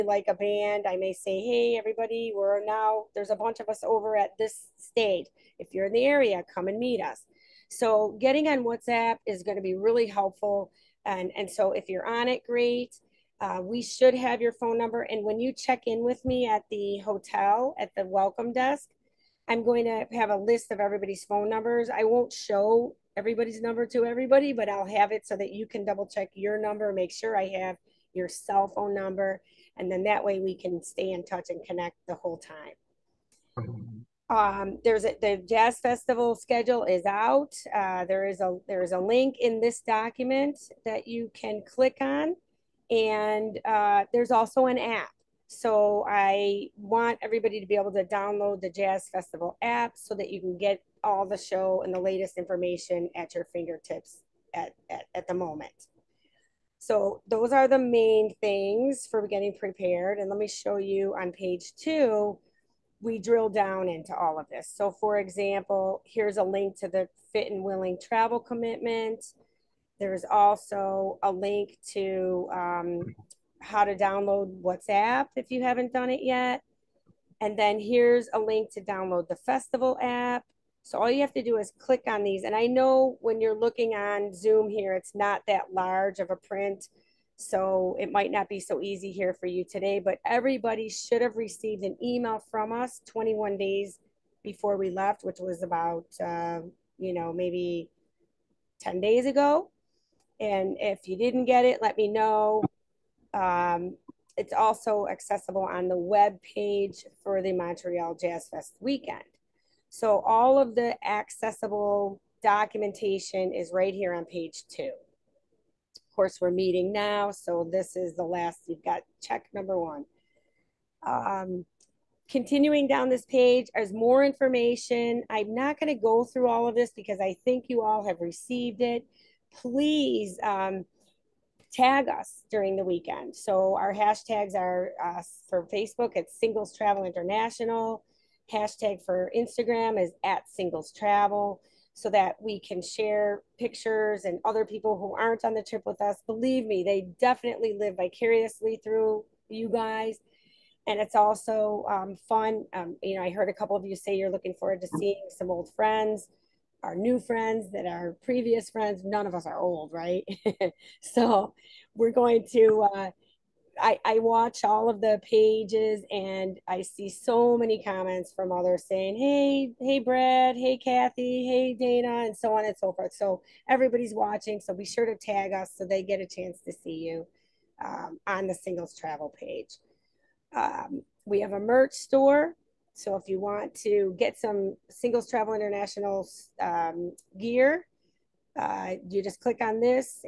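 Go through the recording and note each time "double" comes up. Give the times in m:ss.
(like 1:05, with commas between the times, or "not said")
0:25.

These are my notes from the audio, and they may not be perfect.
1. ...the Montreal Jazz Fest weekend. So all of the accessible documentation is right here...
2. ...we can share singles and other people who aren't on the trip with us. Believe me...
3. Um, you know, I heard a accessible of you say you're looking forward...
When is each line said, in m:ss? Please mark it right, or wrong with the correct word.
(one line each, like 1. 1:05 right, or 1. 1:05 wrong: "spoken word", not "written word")
1. 1:47 right
2. 2:22 wrong: "pictures", not "singles"
3. 2:32 wrong: "couple", not "accessible".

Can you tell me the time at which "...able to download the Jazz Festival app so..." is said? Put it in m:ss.
0:47.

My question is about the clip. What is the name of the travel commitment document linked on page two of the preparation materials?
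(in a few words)
fit and willing travel commitment.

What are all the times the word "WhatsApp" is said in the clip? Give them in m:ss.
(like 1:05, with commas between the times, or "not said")
0:08, 1:14.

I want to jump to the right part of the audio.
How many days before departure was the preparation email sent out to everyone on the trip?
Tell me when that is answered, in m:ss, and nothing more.
1:33.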